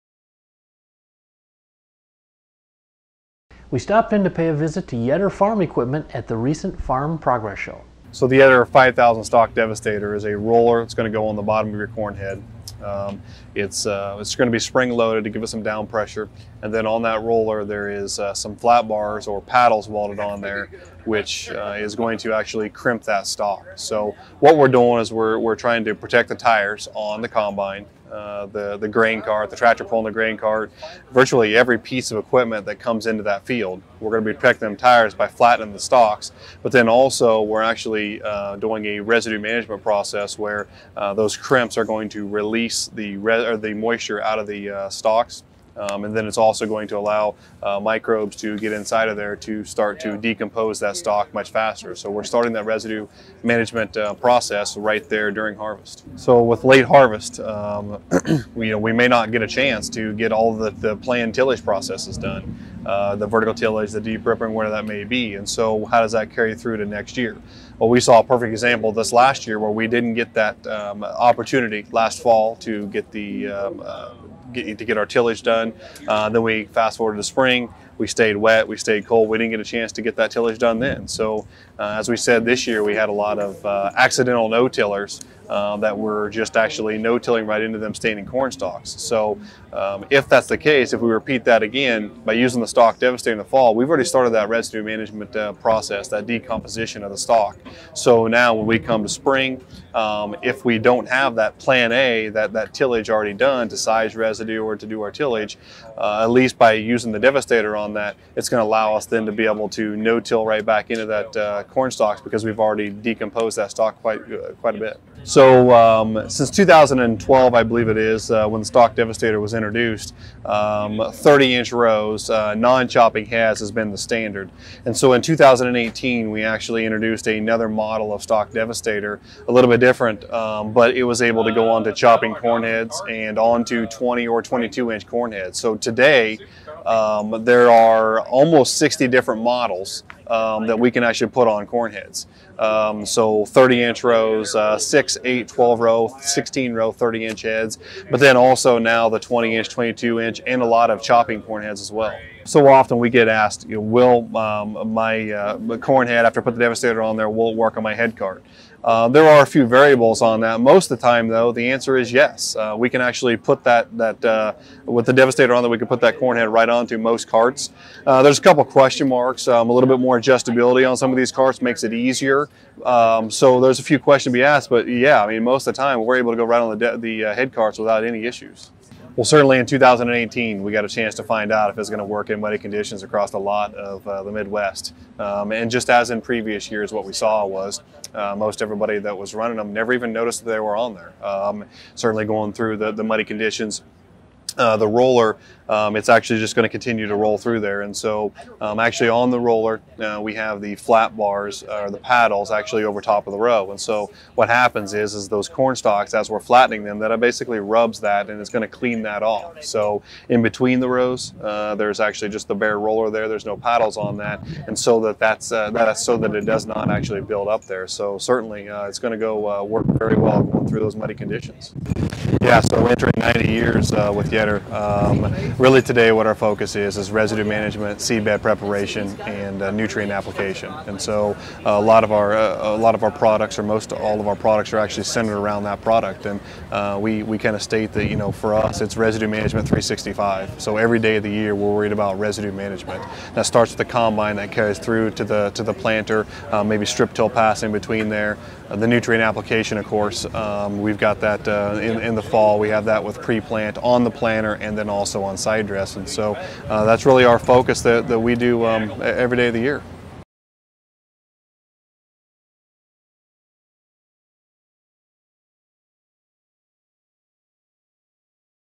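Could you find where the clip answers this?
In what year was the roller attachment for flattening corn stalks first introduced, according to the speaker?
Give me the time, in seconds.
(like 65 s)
116 s.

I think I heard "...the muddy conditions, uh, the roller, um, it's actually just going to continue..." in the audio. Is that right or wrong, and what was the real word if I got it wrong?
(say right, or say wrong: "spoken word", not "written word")
right.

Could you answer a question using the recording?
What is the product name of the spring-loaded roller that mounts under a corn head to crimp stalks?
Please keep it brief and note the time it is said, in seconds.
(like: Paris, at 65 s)
Yetter 5000 Stalk Devastator, at 8 s.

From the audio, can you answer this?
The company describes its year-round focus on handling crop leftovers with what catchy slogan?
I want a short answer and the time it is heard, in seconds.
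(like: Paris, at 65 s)
residue management 365, at 238 s.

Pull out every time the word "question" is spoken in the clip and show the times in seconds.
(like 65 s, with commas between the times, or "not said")
168 s, 173 s.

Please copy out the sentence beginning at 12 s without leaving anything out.
Um, it's, uh, it's going to be spring loaded to give us some down pressure.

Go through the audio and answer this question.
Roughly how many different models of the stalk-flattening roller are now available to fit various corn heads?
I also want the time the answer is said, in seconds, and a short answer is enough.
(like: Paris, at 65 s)
60, at 138 s.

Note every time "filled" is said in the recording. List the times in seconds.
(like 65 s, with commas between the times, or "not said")
not said.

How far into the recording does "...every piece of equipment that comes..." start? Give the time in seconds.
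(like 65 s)
31 s.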